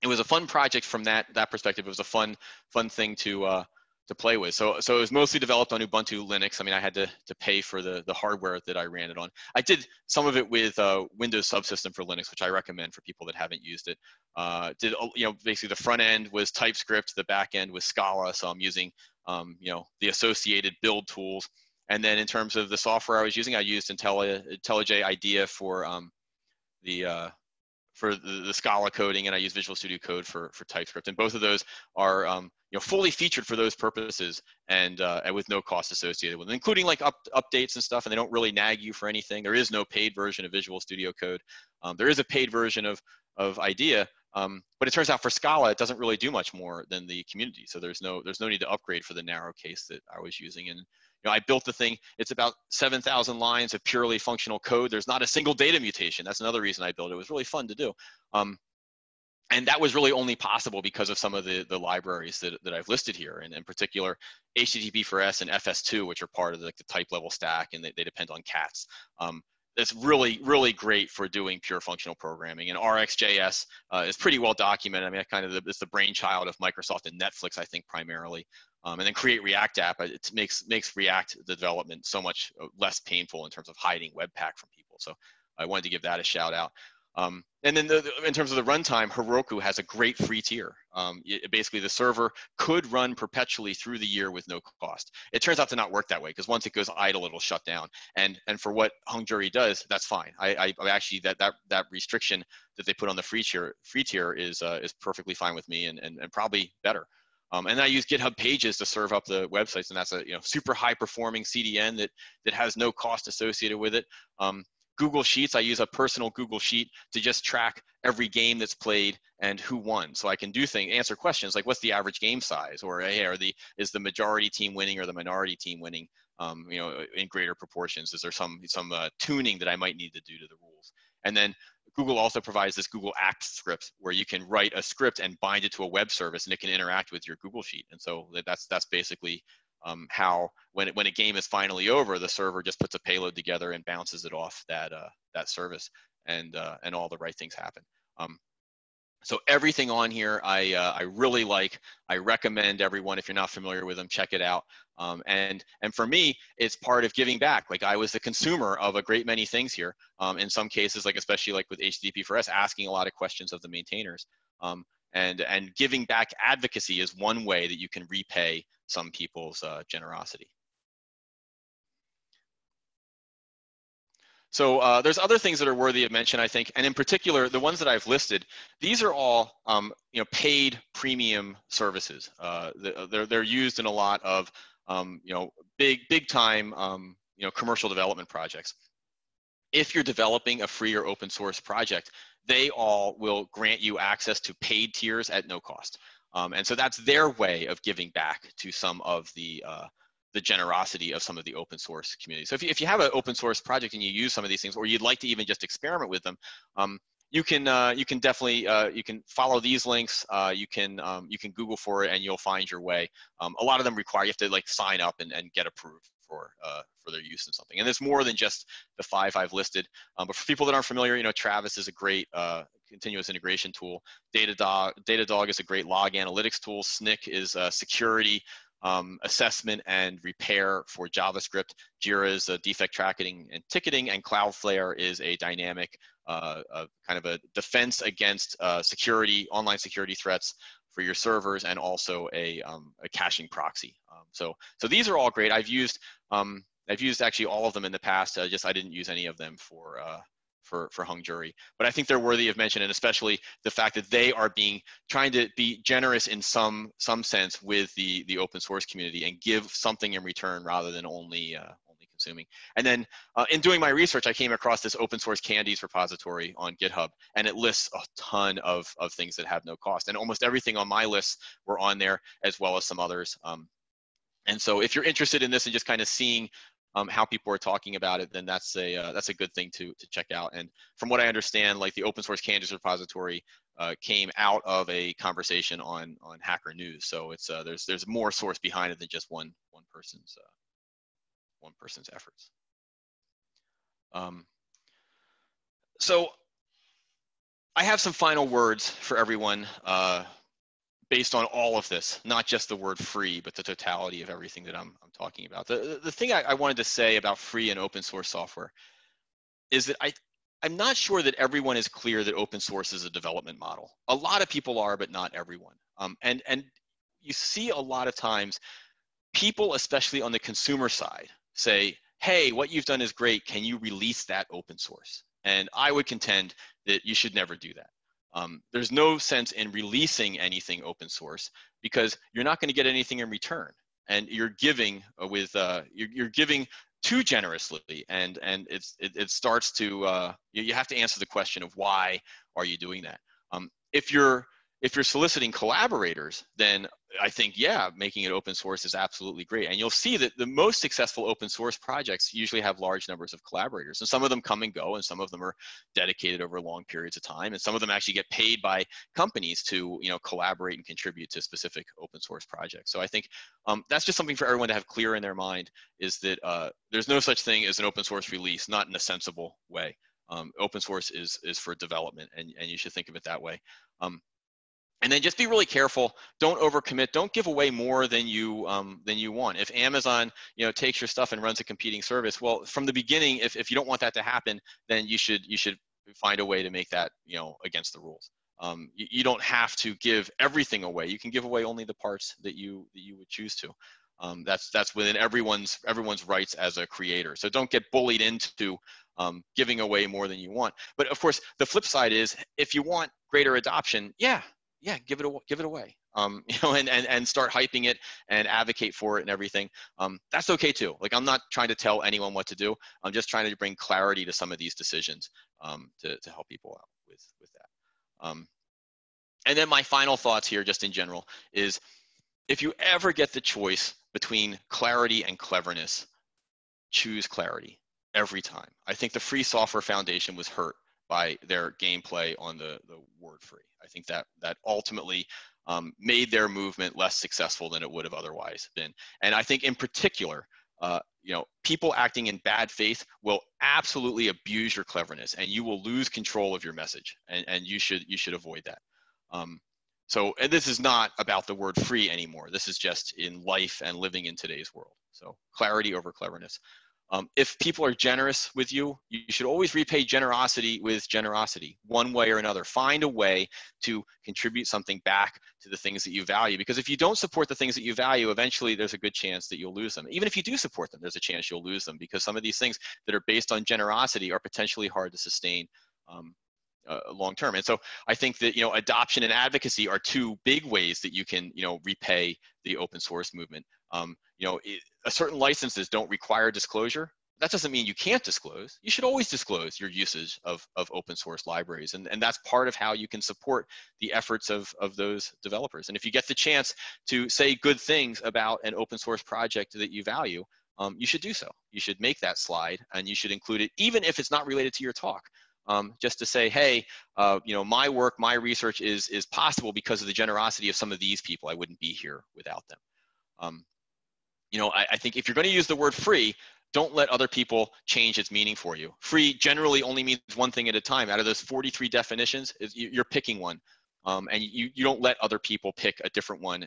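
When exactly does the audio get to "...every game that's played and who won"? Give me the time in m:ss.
1:58.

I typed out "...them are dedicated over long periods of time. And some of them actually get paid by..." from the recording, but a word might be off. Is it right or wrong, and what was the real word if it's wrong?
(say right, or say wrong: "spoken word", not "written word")
right.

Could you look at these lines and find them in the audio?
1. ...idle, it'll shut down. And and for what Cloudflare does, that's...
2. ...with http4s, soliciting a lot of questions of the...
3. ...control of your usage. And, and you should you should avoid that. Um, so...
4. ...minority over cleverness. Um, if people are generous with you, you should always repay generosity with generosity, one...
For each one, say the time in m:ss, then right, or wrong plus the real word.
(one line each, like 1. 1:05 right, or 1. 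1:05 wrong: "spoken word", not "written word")
1. 1:36 wrong: "Jury", not "Cloudflare"
2. 2:41 wrong: "asking", not "soliciting"
3. 7:26 wrong: "message", not "usage"
4. 7:35 wrong: "clarity", not "minority".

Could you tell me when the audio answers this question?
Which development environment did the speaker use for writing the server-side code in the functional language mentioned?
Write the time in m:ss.
0:23.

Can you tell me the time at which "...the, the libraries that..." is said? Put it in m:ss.
1:01.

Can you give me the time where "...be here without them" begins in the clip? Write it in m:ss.
8:31.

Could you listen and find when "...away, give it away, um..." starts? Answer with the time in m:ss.
6:45.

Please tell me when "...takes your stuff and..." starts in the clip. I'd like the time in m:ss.
6:20.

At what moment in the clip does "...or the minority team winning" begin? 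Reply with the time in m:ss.
2:04.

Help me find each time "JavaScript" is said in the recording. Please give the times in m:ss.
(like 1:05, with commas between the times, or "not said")
3:51.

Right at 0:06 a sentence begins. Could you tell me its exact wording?
I mean, I had to, to pay for the, the hardware that I ran it on.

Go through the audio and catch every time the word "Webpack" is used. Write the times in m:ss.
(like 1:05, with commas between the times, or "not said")
1:24.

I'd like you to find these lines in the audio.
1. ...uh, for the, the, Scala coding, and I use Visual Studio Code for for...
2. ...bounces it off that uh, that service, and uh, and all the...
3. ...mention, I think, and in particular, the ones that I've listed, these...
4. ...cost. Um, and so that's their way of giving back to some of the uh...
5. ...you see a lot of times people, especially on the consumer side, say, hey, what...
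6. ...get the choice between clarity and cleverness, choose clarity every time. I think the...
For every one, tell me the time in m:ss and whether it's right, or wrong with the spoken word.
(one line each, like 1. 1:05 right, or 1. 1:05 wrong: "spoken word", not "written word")
1. 0:27 right
2. 2:23 right
3. 2:56 right
4. 3:15 right
5. 5:17 right
6. 7:03 right.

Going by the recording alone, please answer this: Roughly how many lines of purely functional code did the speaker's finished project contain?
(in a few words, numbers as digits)
7,000.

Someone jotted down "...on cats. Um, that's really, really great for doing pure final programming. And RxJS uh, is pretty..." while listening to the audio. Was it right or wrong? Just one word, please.
wrong.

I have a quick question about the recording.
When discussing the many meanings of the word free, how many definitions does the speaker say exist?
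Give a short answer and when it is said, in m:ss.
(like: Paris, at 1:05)
43, at 8:41.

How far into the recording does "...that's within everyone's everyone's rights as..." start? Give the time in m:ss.
6:34.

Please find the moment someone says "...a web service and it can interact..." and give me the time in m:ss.
2:15.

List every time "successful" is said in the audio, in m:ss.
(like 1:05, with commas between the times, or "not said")
5:50, 7:17.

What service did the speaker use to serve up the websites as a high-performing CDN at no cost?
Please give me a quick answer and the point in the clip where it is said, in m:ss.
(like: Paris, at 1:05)
GitHub Pages, at 1:48.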